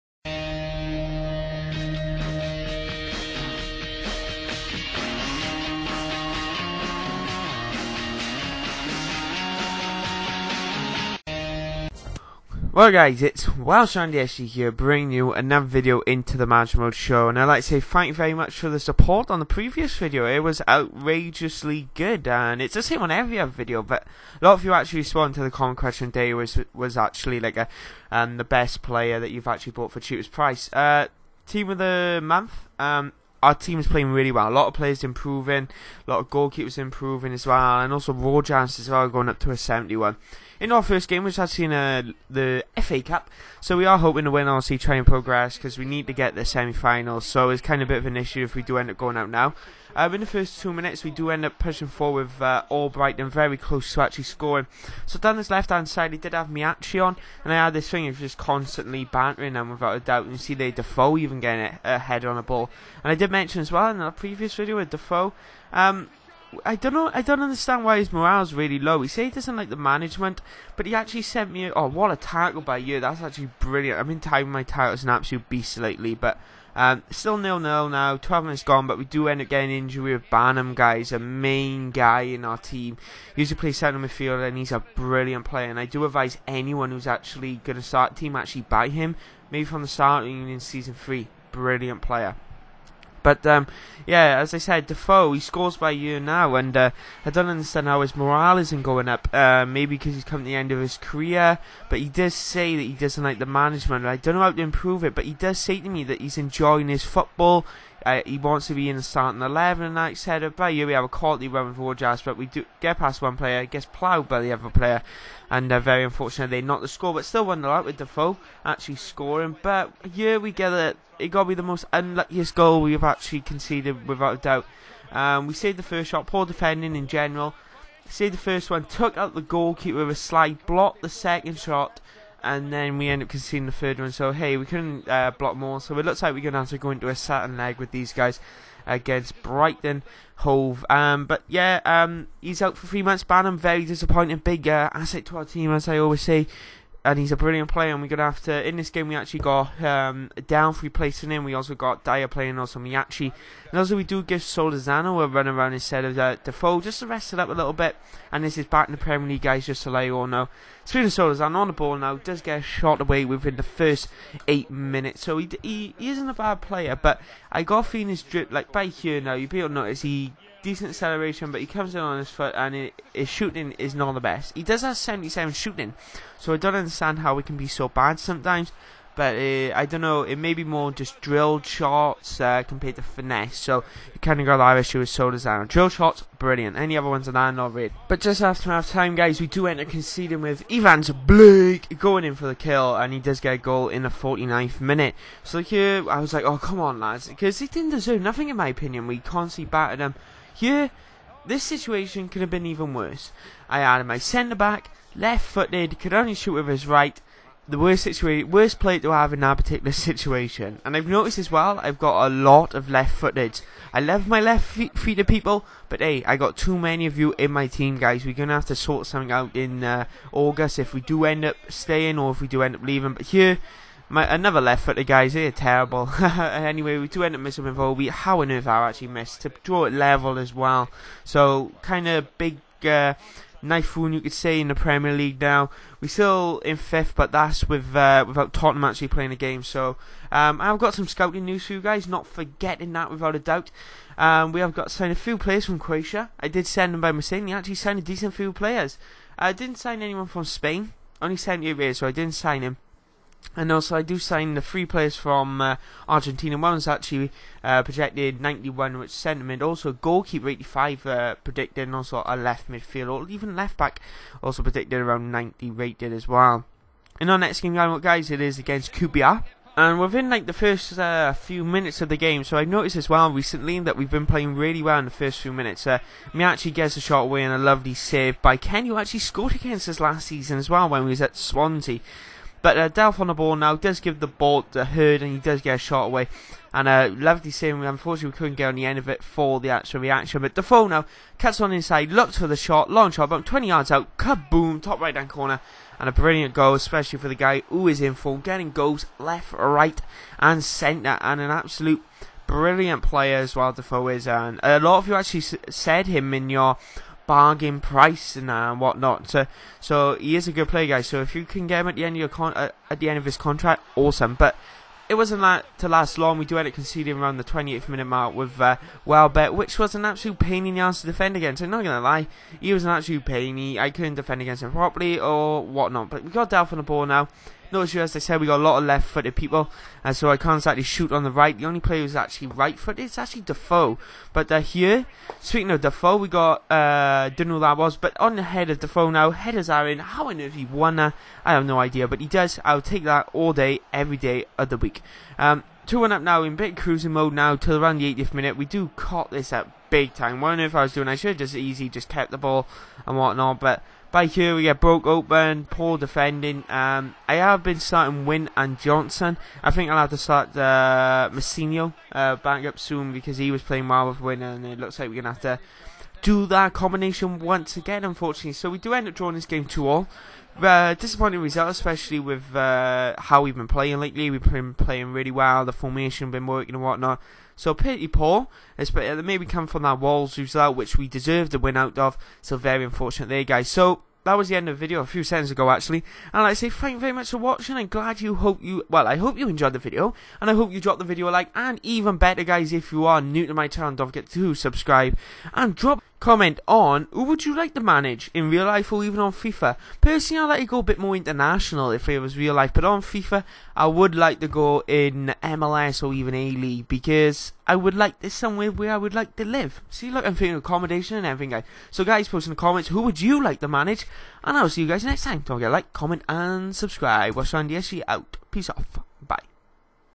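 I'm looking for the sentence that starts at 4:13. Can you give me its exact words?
And also, I do sign the three players from uh, Argentina.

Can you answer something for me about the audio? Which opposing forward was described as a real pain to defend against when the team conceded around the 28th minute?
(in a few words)
Welbeck.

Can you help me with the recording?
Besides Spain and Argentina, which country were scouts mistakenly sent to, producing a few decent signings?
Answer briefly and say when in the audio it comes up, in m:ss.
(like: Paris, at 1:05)
Croatia, at 4:05.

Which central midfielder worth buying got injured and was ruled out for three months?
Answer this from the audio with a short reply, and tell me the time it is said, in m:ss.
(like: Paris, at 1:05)
Bannan, at 1:20.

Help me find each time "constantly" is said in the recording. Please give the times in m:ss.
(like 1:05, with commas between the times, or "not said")
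0:58, 3:19.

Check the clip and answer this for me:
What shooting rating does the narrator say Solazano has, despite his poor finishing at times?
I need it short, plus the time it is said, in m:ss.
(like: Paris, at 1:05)
77, at 2:54.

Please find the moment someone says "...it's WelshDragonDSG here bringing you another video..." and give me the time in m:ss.
0:13.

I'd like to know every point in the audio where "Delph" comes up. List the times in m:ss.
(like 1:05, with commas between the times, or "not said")
4:42, 5:26.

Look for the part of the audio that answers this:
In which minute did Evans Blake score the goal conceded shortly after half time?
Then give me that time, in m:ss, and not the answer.
3:14.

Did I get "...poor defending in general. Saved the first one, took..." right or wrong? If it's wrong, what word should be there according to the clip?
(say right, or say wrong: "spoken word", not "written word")
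right.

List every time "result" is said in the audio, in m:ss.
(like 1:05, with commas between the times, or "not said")
6:11, 6:20.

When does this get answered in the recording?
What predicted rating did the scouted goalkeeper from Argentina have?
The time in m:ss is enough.
4:20.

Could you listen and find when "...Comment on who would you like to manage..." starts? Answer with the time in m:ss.
6:36.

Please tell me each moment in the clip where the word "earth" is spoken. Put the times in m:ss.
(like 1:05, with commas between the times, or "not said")
3:48, 5:40.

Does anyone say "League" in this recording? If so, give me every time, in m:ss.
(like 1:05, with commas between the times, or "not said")
2:39, 3:55, 6:46.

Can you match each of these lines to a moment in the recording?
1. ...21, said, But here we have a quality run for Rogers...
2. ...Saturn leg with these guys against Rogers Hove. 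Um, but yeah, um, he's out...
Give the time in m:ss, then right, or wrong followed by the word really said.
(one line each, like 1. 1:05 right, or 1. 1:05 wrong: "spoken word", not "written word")
1. 1:49 wrong: "11", not "21"
2. 2:17 wrong: "Brighton", not "Rogers".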